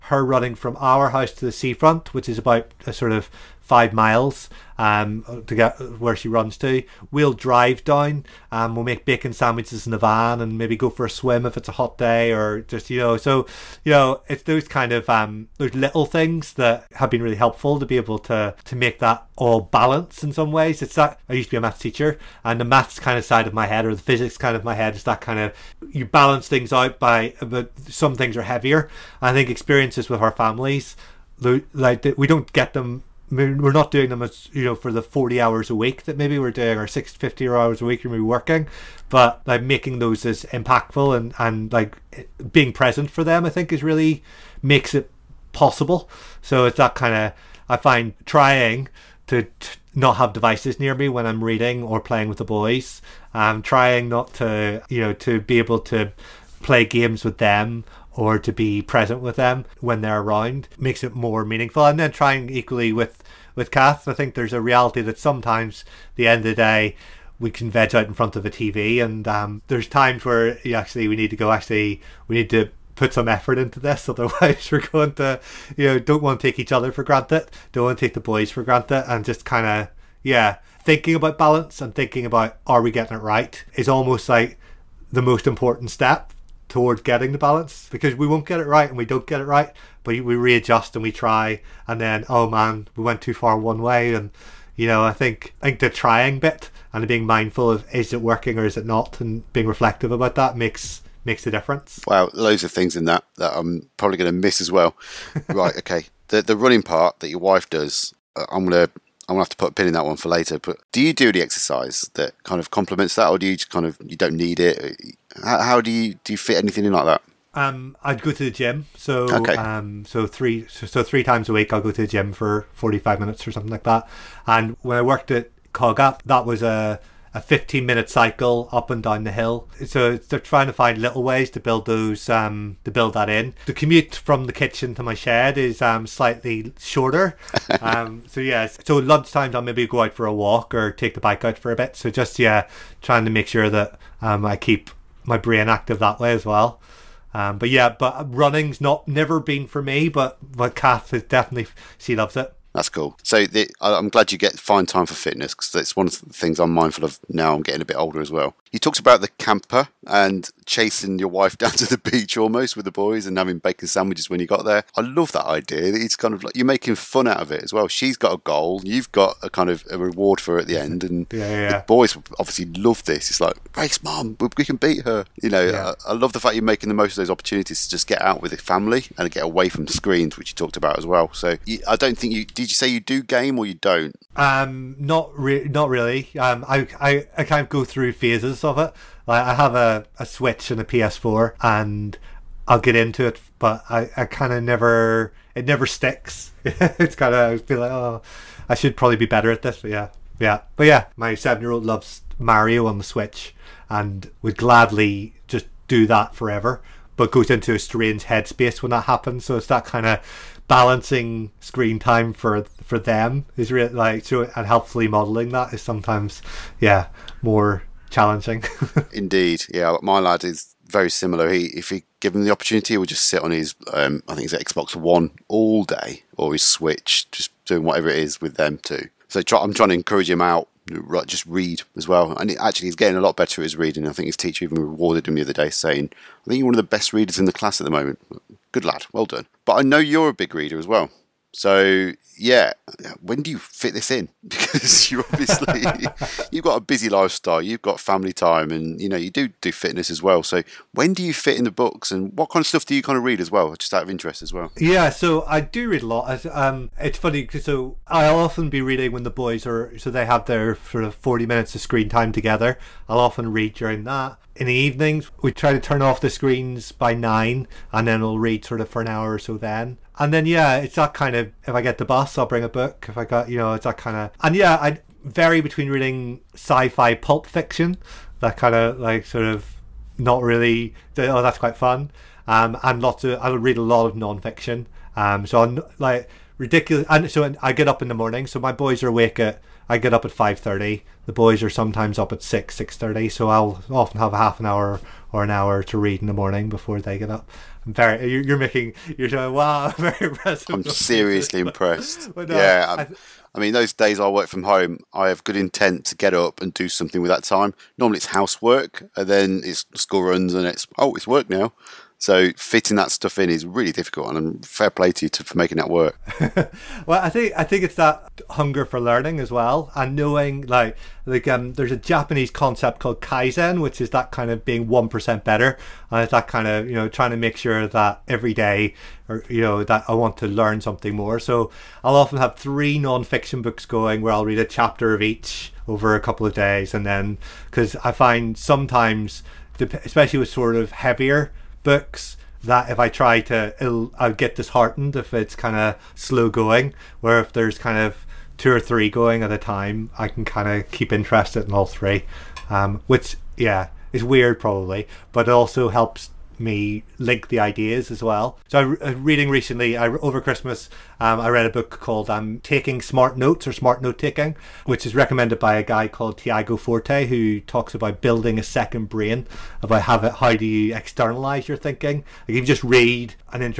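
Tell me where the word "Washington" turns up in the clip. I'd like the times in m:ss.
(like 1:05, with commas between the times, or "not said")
not said.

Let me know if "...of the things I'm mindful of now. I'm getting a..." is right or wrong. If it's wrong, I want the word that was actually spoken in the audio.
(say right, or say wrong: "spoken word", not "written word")
right.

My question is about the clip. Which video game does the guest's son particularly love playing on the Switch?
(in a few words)
Mario.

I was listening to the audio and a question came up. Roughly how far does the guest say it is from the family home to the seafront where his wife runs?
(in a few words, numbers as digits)
5 miles.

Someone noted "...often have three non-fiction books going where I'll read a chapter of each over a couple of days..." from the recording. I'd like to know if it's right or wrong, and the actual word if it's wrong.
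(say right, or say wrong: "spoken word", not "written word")
right.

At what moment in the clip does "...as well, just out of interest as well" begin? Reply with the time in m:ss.
4:13.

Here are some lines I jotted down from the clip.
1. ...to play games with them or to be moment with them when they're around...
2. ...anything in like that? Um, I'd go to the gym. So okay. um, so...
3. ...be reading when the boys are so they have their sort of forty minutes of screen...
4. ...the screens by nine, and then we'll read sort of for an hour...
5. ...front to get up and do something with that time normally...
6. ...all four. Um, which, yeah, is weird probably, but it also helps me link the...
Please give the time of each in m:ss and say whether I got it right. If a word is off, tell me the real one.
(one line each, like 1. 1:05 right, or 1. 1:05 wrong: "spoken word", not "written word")
1. 0:55 wrong: "present", not "moment"
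2. 1:56 right
3. 4:18 right
4. 4:26 right
5. 5:05 wrong: "intent", not "front"
6. 5:51 wrong: "three", not "four".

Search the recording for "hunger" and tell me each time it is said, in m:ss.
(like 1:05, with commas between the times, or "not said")
5:18.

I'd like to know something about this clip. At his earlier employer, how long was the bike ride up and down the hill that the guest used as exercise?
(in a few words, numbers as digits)
15 minutes.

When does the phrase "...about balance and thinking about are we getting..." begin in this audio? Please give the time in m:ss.
1:21.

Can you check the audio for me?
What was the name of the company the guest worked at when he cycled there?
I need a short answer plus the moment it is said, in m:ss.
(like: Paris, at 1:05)
Cogapp, at 2:05.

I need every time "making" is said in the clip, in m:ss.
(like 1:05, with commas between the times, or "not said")
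0:39, 2:46, 2:56, 4:58, 5:15.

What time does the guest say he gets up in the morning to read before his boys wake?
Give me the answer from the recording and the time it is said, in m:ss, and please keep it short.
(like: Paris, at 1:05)
5:30, at 4:50.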